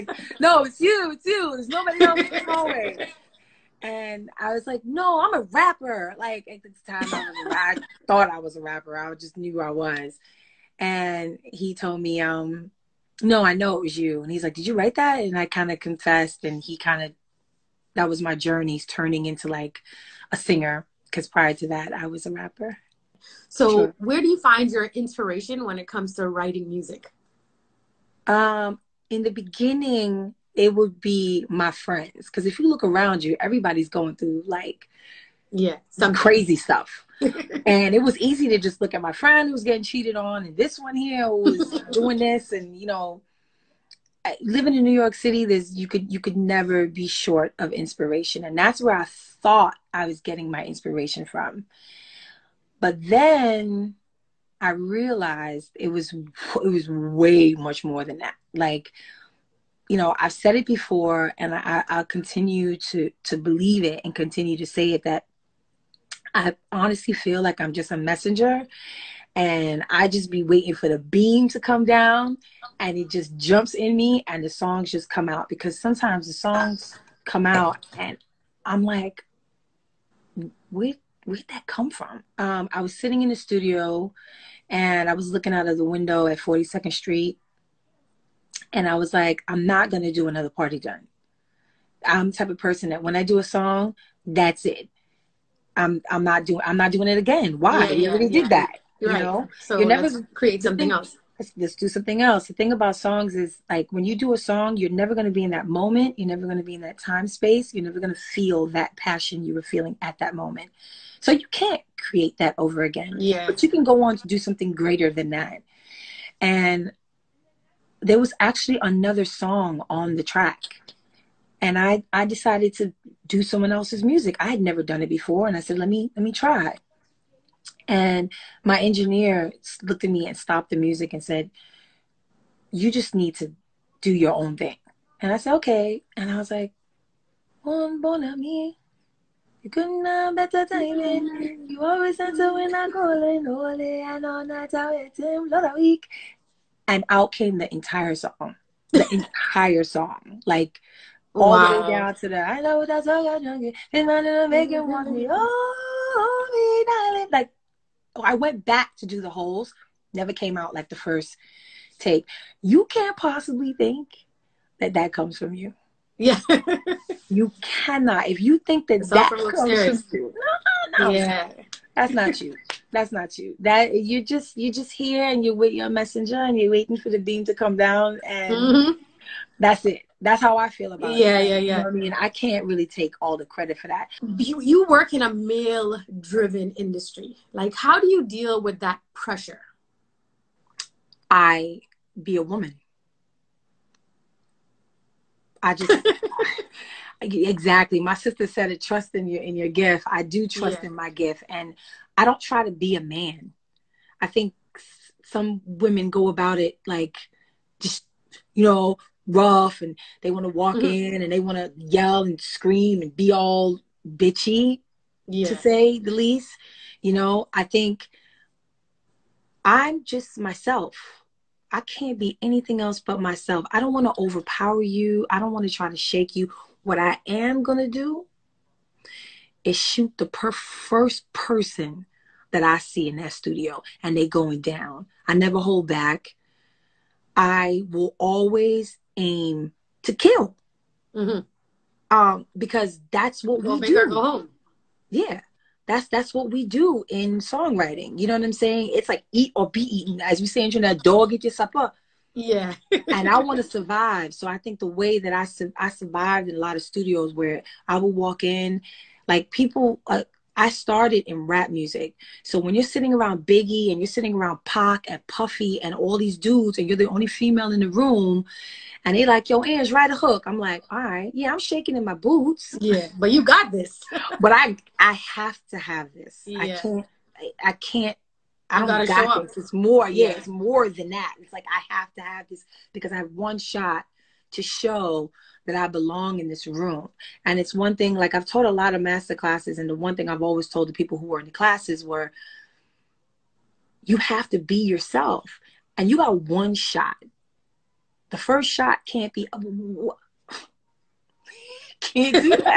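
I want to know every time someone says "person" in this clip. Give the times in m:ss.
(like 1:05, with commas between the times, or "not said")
1:32, 3:51.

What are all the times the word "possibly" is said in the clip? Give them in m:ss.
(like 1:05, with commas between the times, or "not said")
2:43.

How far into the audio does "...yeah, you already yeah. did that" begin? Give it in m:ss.
1:37.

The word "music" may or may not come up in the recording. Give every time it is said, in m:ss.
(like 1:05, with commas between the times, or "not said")
0:26, 2:04, 2:10, 4:21.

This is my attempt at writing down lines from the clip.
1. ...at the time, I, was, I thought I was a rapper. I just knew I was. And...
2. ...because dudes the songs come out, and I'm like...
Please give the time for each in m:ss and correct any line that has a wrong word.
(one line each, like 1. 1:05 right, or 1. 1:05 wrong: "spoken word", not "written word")
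1. 0:06 right
2. 1:15 wrong: "sometimes", not "dudes".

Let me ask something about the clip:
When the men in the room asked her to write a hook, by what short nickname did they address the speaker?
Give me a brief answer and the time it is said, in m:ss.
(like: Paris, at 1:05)
Ange, at 4:29.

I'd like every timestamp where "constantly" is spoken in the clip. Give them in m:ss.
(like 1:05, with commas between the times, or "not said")
not said.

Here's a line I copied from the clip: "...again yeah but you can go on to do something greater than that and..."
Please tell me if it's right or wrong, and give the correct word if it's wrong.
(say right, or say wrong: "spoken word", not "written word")
right.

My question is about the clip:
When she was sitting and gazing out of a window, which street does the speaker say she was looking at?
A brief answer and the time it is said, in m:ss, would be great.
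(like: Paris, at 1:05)
42nd Street, at 1:26.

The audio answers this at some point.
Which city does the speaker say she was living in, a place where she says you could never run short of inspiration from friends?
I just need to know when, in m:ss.
0:44.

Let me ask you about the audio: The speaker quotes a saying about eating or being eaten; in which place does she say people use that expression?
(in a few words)
Trinidad.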